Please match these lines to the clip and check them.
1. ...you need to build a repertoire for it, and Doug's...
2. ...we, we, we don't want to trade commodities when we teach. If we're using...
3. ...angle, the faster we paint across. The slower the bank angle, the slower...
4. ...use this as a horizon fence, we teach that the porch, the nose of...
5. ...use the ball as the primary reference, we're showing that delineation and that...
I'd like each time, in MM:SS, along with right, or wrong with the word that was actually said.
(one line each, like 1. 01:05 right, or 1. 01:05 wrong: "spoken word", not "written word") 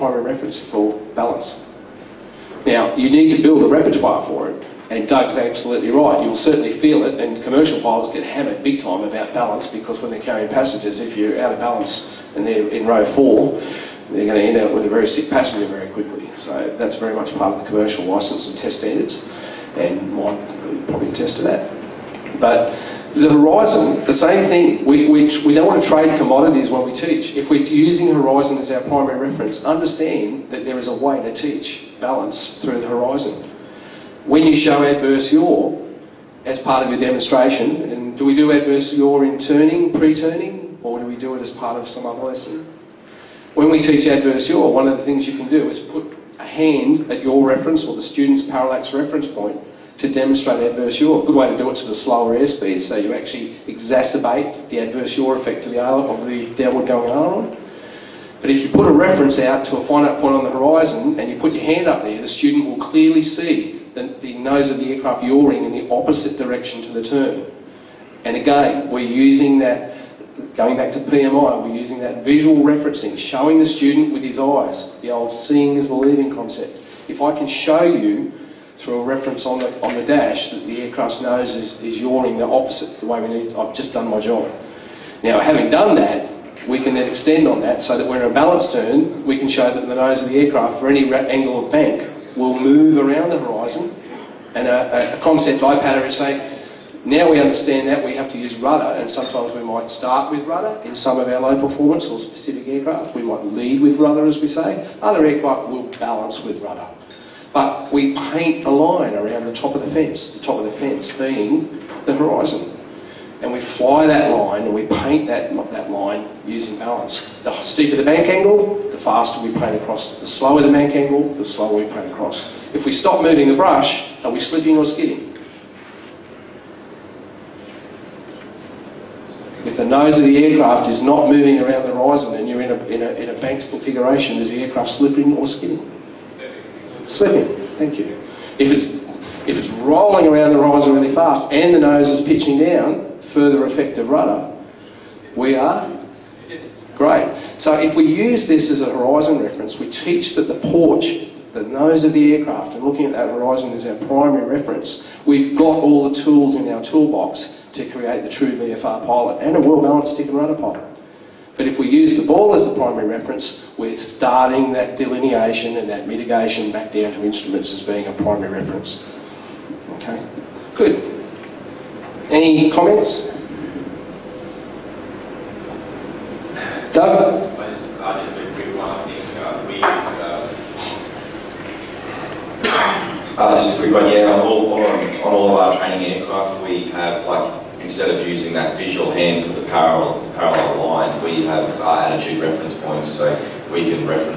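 1. 00:02 right
2. 00:24 right
3. 01:58 right
4. 02:28 wrong: "reference", not "fence"
5. 02:41 wrong: "starting", not "showing".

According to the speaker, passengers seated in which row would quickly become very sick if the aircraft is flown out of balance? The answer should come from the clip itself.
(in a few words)
Row 4.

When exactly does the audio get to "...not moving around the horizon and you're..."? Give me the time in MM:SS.
02:11.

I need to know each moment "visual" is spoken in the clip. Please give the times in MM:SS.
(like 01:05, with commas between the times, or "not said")
01:12, 03:08.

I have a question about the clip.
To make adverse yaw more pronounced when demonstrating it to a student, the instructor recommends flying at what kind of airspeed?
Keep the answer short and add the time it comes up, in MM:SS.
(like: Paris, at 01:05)
Slower airspeed, at 00:51.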